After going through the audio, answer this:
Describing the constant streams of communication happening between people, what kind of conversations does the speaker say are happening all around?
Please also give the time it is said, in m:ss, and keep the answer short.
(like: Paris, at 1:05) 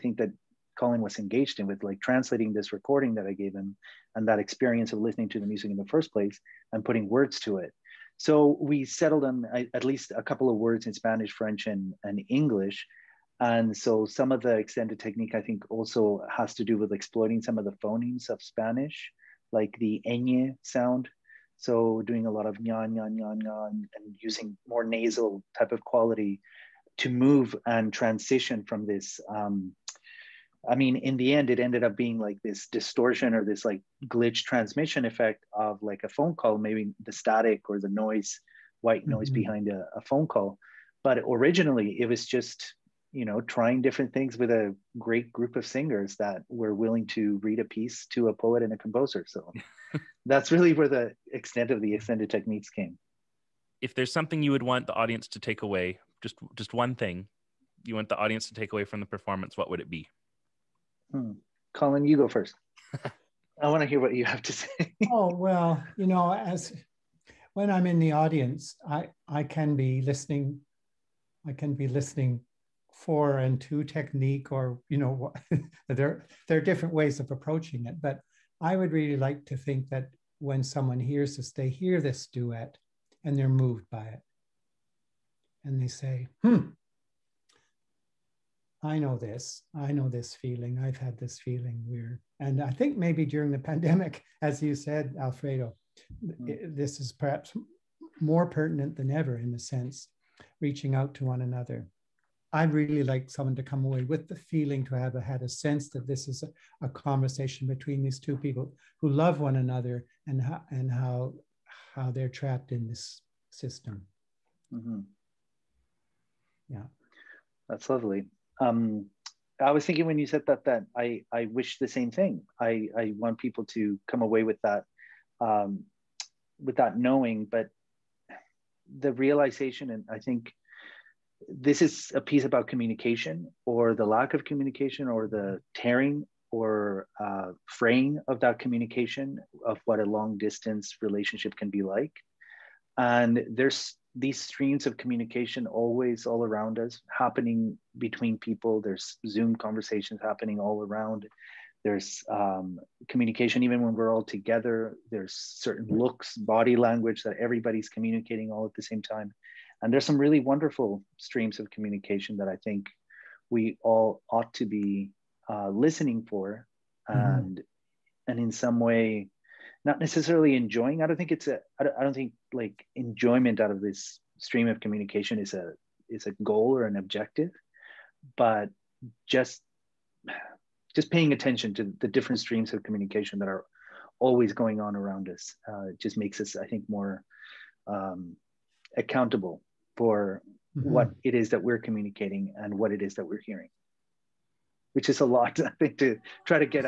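Zoom conversations, at 2:29.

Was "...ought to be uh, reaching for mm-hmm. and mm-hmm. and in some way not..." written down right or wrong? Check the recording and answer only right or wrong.
wrong.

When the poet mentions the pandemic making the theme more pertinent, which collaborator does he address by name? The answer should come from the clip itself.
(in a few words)
Alfredo.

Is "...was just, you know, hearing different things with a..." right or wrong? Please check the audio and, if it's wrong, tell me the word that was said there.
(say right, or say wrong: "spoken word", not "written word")
wrong: "trying", not "hearing".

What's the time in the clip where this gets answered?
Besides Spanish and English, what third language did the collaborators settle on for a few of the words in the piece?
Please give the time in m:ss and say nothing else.
0:11.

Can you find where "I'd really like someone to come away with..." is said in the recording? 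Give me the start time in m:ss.
1:42.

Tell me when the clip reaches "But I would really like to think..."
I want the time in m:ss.
1:18.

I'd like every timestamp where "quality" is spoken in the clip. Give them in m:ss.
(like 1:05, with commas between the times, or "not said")
0:25.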